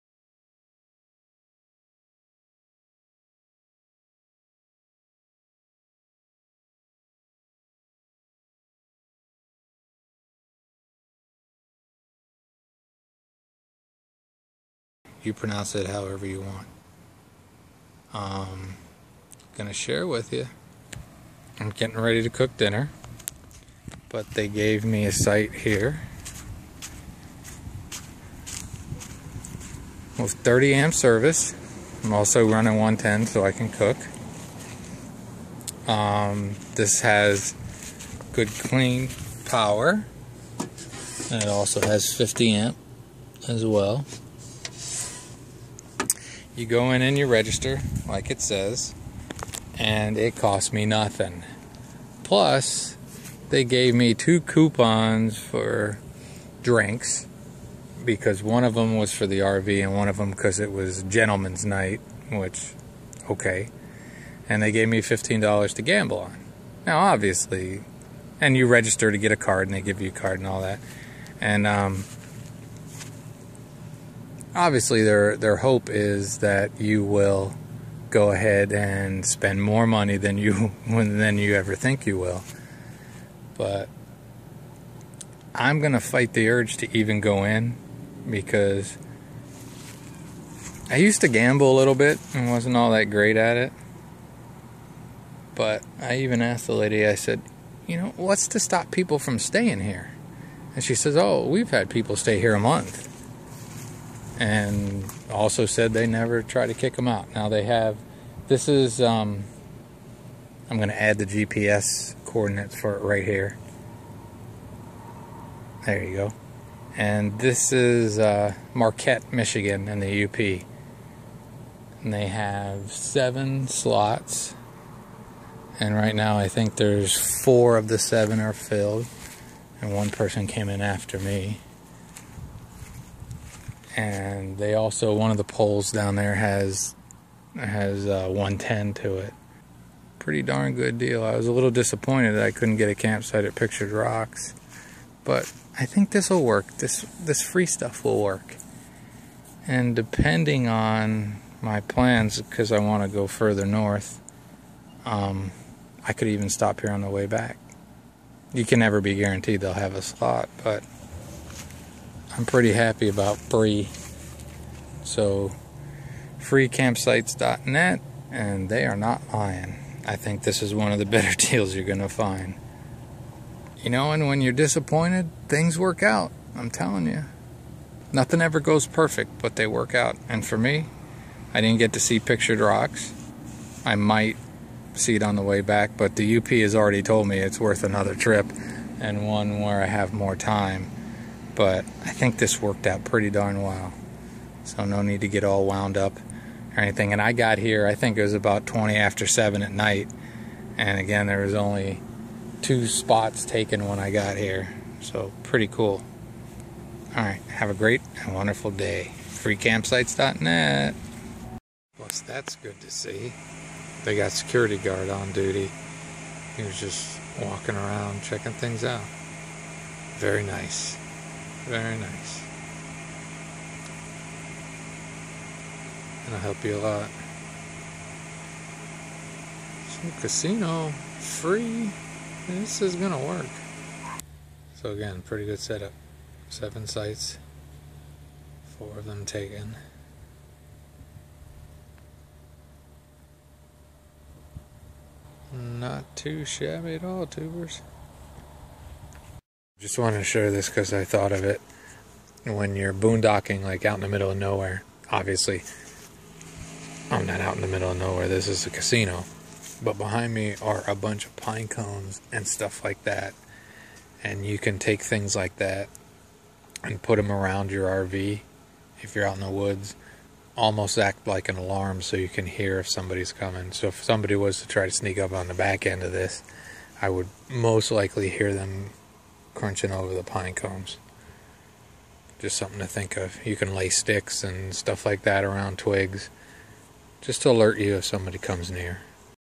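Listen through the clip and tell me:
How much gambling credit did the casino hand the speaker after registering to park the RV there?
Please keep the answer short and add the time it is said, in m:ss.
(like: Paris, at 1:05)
$15, at 1:05.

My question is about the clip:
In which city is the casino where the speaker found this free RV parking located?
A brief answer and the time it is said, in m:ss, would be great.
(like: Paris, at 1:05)
Marquette, Michigan, at 1:58.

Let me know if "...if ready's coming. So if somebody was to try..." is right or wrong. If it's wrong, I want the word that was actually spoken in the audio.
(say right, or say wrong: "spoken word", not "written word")
wrong: "somebody", not "ready".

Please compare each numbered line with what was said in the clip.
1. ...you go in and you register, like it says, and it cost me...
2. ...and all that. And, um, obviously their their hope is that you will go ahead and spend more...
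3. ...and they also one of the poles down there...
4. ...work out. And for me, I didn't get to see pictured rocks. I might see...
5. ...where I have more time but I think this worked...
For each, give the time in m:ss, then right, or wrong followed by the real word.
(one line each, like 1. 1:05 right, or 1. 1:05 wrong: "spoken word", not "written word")
1. 0:46 right
2. 1:10 right
3. 2:13 right
4. 2:59 right
5. 3:09 right.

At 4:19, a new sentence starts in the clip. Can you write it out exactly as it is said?
But behind me are a bunch of pine cones and stuff like that.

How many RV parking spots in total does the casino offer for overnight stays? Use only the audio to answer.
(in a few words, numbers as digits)
7.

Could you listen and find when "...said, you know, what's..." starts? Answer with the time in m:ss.
1:37.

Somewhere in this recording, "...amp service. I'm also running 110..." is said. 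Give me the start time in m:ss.
0:30.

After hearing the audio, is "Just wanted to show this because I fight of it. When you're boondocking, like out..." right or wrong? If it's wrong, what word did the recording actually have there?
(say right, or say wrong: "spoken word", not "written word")
wrong: "thought", not "fight".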